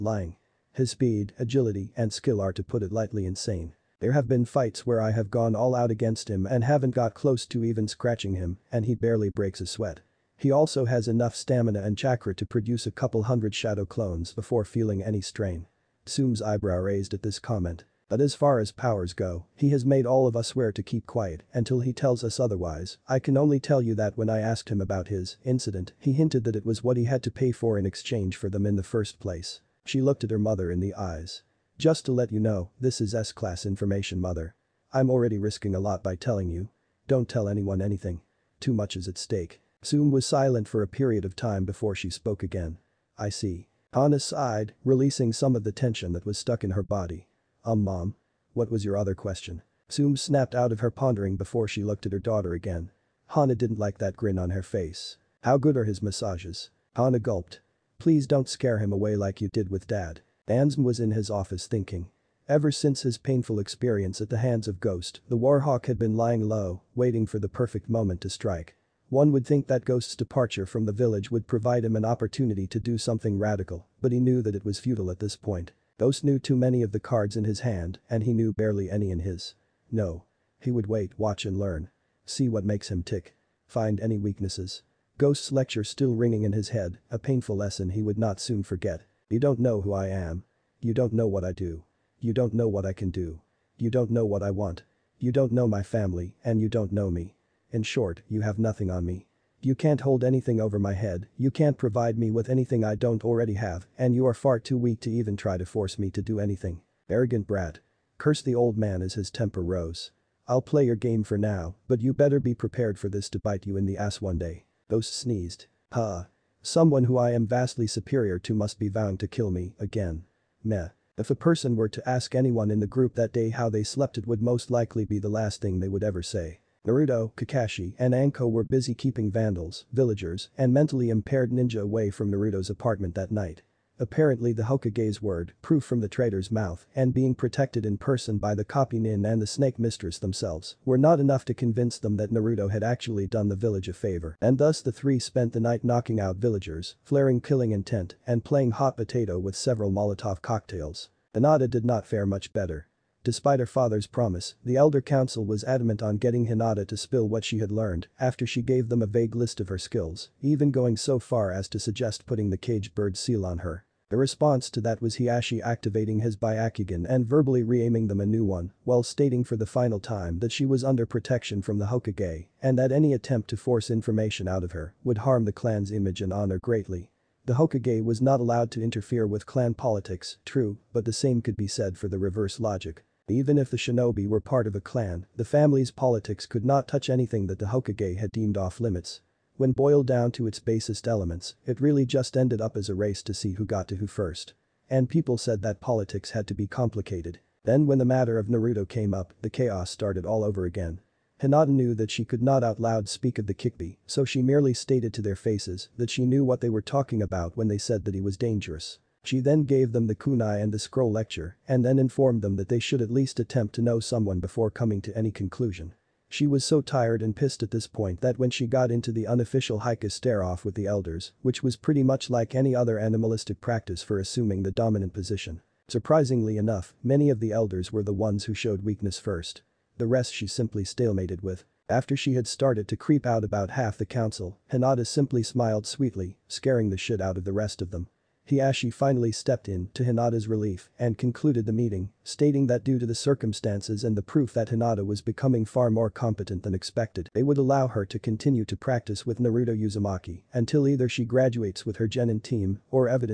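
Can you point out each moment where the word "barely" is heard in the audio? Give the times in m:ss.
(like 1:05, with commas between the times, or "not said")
0:08, 1:18.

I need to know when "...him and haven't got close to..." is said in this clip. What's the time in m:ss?
0:06.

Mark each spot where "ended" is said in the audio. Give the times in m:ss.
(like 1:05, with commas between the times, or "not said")
3:12.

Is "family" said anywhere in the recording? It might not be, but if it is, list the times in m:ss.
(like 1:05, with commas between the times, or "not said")
1:35, 3:05.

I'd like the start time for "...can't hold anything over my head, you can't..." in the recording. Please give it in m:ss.
1:39.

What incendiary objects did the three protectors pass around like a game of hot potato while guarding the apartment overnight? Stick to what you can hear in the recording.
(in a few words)
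Molotov cocktails.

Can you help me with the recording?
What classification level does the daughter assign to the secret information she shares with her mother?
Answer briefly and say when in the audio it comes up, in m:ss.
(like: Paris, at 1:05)
S-class, at 0:33.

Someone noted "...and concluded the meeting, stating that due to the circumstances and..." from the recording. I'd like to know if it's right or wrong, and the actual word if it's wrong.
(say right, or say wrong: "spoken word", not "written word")
right.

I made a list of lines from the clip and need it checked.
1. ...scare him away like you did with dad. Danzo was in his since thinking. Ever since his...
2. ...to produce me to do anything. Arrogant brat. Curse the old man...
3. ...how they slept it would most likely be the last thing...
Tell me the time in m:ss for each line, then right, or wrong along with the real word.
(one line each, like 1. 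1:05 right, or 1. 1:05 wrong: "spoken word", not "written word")
1. 0:58 wrong: "office", not "since"
2. 1:45 wrong: "force", not "produce"
3. 2:03 right.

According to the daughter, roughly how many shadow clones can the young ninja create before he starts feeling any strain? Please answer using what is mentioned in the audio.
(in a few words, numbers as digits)
a couple hundred.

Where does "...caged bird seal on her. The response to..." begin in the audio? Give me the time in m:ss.
2:42.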